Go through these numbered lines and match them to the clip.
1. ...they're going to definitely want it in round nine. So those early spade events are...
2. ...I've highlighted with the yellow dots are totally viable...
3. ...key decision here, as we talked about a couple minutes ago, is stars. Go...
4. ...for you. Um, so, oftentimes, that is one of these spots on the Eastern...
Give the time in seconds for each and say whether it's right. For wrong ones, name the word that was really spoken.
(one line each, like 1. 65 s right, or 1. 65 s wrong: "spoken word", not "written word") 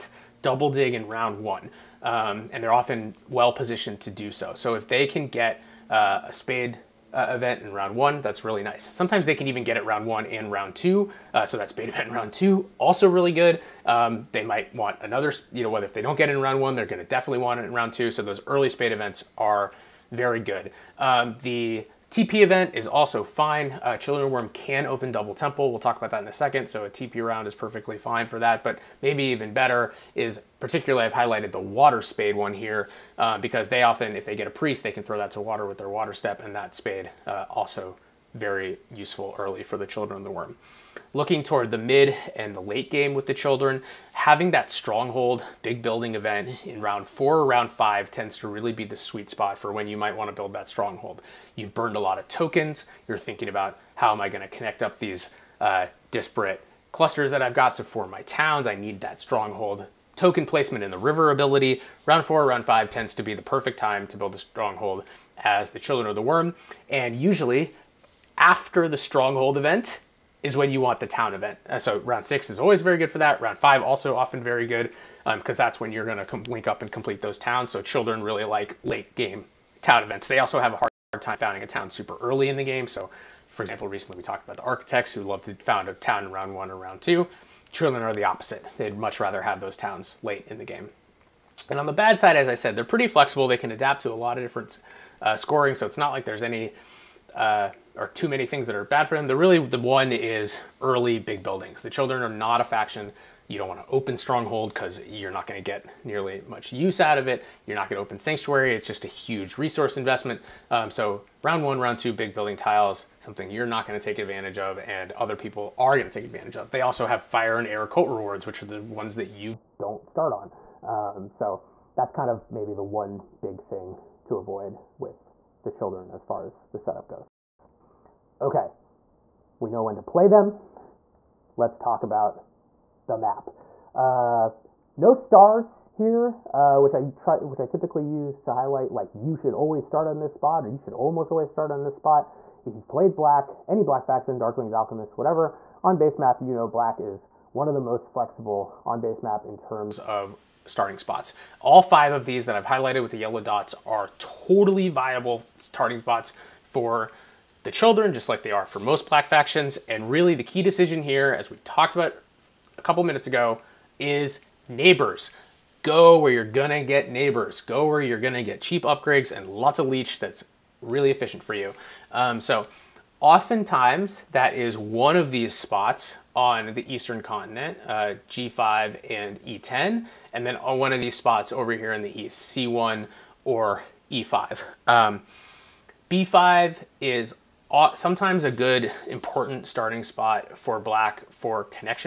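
1. 16 s wrong: "two", not "nine"
2. 152 s right
3. 160 s wrong: "neighbors", not "stars"
4. 171 s right.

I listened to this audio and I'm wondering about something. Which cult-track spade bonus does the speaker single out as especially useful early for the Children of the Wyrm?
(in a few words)
Water Spade.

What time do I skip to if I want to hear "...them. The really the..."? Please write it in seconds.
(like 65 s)
99 s.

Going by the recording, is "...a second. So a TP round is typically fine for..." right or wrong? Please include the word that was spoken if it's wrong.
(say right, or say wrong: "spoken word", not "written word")
wrong: "perfectly", not "typically".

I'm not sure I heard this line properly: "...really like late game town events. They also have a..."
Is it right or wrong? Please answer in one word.
right.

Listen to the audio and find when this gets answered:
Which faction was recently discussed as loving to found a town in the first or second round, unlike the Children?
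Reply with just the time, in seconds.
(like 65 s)
84 s.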